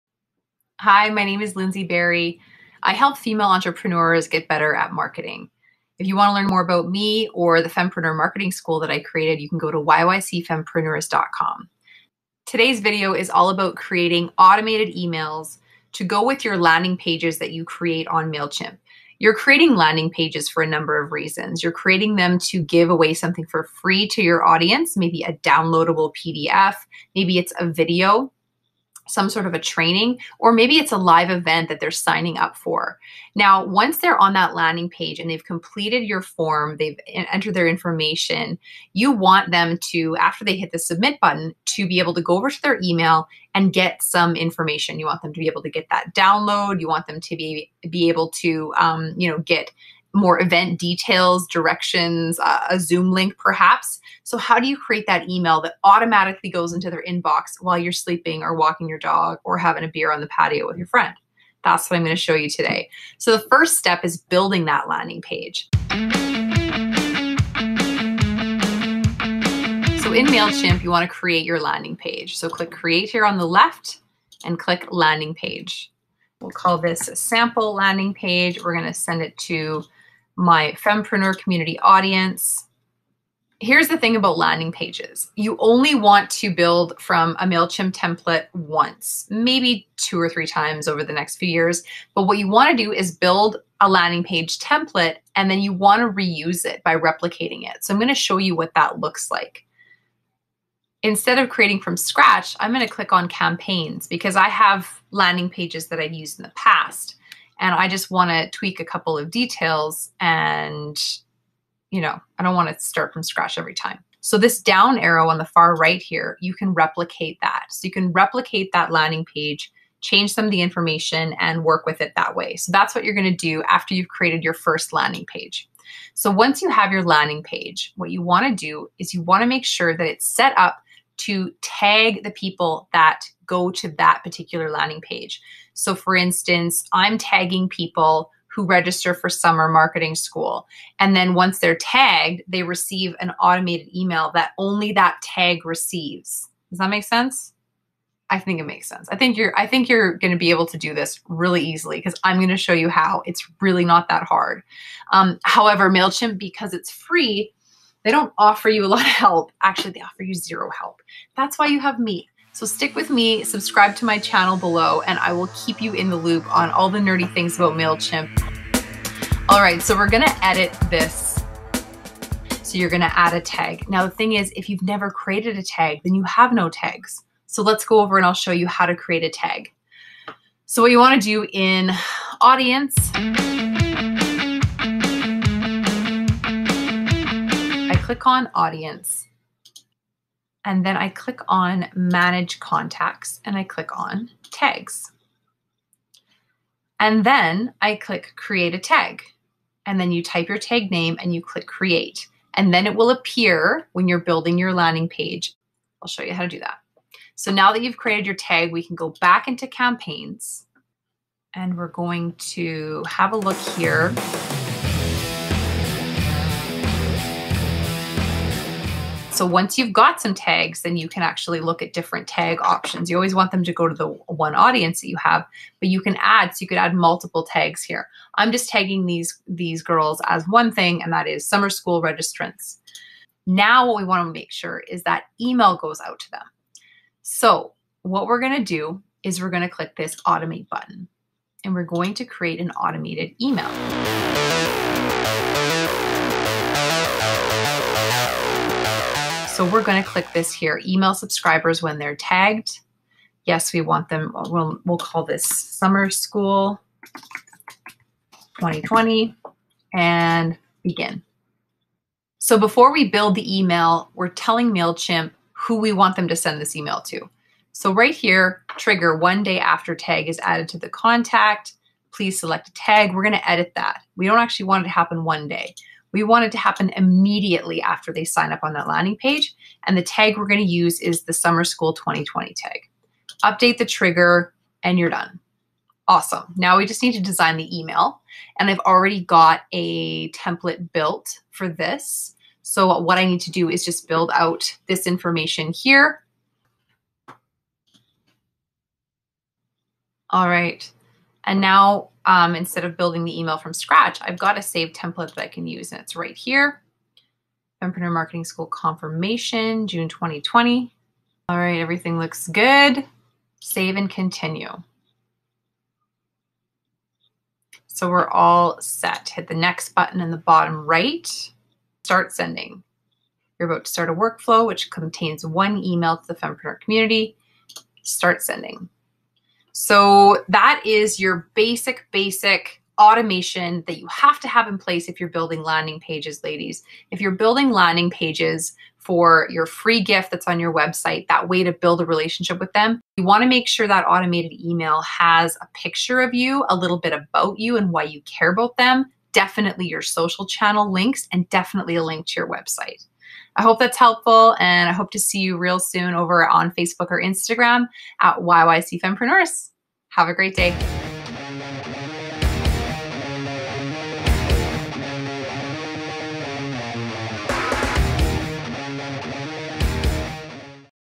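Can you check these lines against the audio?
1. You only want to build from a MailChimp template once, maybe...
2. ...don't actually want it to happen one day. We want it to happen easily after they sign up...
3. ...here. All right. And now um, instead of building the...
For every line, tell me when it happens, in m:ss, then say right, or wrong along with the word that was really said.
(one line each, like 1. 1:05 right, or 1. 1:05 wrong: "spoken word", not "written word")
1. 1:25 right
2. 4:34 wrong: "immediately", not "easily"
3. 4:55 right.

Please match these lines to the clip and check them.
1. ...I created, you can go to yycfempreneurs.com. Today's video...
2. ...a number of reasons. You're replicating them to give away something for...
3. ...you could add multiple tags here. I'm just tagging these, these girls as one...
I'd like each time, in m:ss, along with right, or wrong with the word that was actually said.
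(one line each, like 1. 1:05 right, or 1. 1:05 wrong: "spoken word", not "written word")
1. 0:08 right
2. 0:20 wrong: "creating", not "replicating"
3. 3:46 right.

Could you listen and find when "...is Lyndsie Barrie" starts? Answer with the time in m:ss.
0:01.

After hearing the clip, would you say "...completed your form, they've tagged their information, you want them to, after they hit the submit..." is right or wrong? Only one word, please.
wrong.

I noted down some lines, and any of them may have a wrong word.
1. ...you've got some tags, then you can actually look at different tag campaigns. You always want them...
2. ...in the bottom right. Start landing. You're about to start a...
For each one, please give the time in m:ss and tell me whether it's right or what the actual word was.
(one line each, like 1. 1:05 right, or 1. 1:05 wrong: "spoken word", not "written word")
1. 3:39 wrong: "options", not "campaigns"
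2. 5:20 wrong: "sending", not "landing".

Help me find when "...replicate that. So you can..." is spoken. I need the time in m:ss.
1:56.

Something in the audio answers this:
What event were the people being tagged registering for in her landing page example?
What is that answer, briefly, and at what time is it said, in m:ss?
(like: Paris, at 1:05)
summer marketing school, at 2:19.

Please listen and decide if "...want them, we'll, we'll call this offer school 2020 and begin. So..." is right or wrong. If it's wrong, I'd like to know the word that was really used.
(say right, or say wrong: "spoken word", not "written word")
wrong: "summer", not "offer".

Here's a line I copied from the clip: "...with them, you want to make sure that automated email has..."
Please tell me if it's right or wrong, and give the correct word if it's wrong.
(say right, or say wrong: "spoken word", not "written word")
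right.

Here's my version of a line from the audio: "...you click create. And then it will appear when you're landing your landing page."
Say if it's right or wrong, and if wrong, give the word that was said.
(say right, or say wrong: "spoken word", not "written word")
wrong: "building", not "landing".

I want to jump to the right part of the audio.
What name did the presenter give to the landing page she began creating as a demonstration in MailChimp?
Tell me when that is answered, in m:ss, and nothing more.
1:17.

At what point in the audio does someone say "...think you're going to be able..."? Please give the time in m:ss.
2:29.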